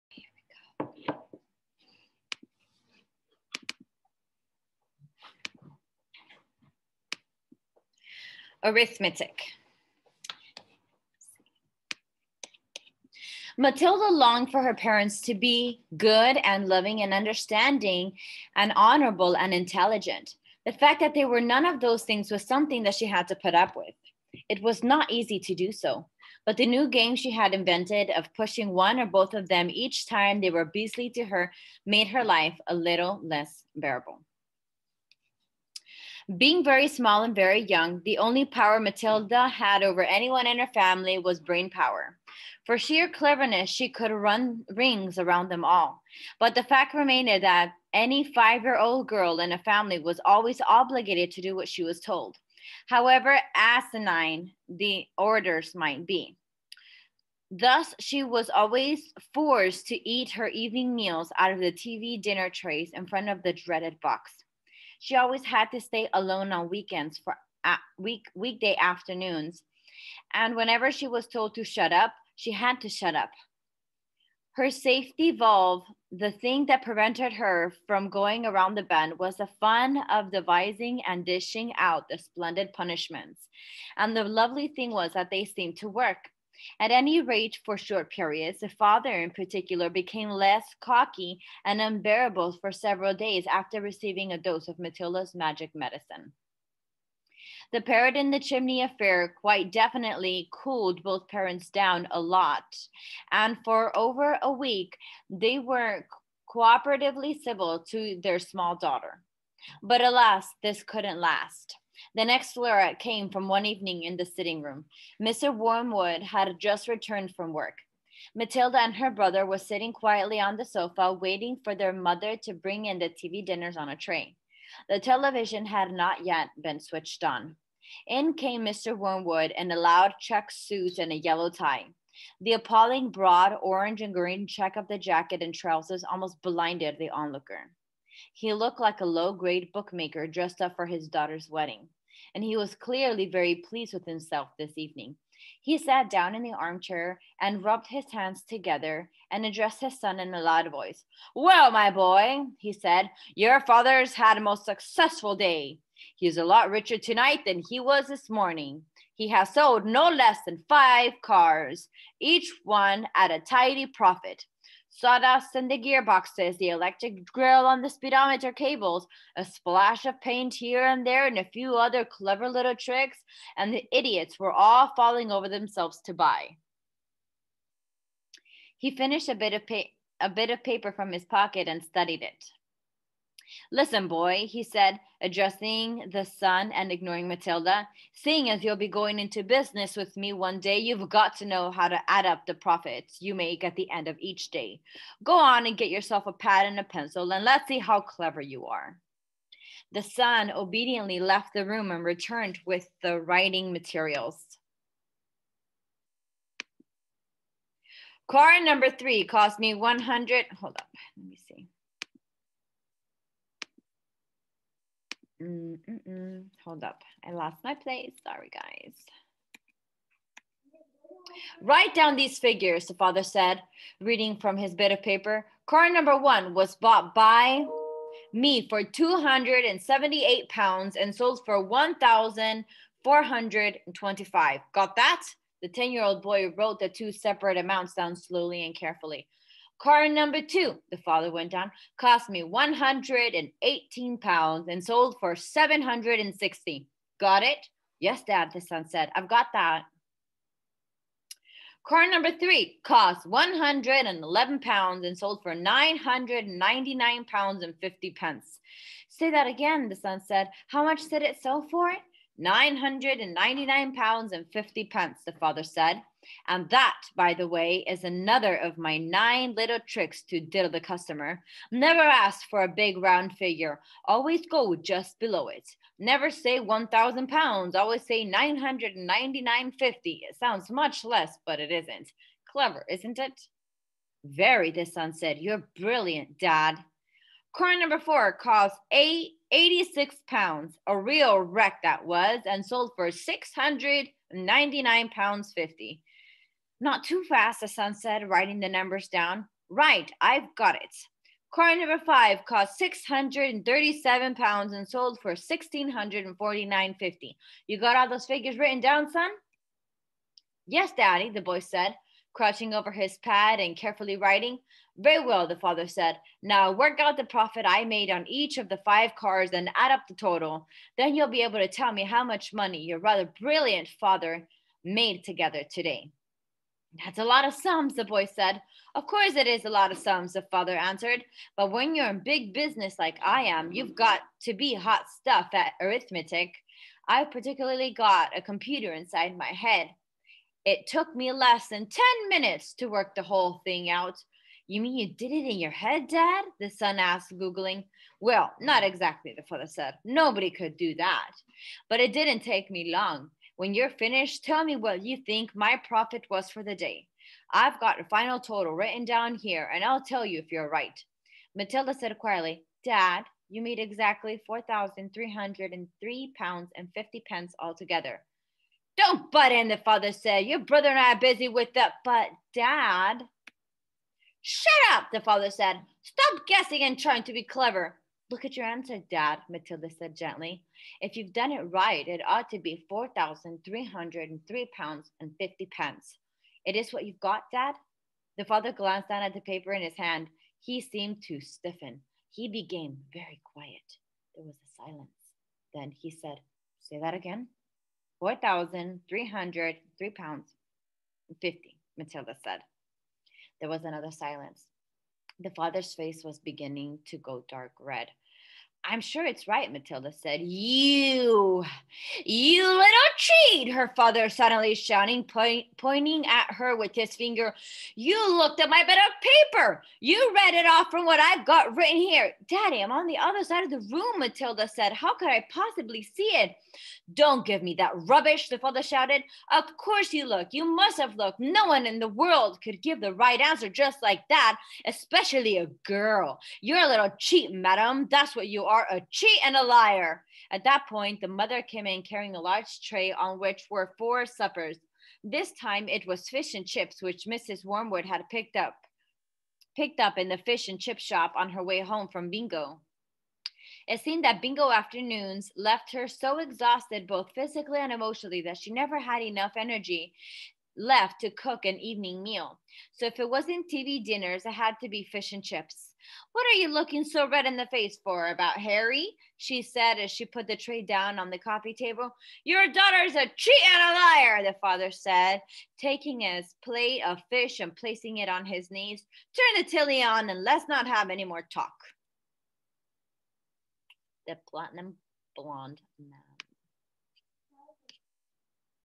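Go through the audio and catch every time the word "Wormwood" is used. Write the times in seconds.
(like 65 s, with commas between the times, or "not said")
115 s, 128 s, 447 s.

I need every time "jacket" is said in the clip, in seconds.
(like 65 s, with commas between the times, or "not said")
134 s.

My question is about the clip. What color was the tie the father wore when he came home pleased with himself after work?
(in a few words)
yellow.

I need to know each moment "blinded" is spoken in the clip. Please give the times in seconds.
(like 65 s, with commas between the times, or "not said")
136 s.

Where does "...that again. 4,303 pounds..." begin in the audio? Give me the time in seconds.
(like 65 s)
396 s.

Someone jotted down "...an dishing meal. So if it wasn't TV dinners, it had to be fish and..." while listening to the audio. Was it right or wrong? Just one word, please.
wrong.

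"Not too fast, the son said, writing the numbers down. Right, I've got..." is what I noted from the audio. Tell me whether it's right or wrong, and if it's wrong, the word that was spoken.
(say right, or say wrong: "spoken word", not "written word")
right.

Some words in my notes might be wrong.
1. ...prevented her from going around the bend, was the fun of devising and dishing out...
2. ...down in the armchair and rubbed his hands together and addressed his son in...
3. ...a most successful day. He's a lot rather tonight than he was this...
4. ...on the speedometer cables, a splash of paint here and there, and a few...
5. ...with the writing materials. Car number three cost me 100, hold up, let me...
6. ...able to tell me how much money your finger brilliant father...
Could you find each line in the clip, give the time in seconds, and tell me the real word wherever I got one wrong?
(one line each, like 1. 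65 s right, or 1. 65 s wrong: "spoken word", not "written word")
1. 76 s right
2. 146 s right
3. 154 s wrong: "richer", not "rather"
4. 167 s right
5. 202 s right
6. 321 s wrong: "rather", not "finger".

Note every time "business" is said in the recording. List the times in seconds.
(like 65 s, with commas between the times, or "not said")
189 s, 332 s.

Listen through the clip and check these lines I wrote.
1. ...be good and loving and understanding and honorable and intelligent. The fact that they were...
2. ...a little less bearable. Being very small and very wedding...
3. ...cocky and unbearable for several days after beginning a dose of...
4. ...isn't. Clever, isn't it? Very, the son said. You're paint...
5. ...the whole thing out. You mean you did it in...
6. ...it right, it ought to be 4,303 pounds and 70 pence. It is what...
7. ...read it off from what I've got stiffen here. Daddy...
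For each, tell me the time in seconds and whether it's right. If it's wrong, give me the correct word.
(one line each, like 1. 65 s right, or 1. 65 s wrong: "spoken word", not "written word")
1. 15 s right
2. 32 s wrong: "young", not "wedding"
3. 90 s wrong: "receiving", not "beginning"
4. 281 s wrong: "brilliant", not "paint"
5. 343 s right
6. 381 s wrong: "50", not "70"
7. 420 s wrong: "written", not "stiffen".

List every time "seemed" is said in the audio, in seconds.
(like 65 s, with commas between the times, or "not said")
85 s, 390 s, 454 s.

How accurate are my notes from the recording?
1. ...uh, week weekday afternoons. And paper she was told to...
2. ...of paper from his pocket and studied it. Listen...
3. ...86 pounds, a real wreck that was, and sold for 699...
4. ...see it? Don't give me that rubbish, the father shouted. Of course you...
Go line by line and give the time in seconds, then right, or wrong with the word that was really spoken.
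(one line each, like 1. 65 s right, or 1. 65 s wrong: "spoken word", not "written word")
1. 67 s wrong: "whenever", not "paper"
2. 180 s right
3. 289 s right
4. 426 s right.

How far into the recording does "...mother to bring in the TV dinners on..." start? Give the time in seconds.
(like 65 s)
121 s.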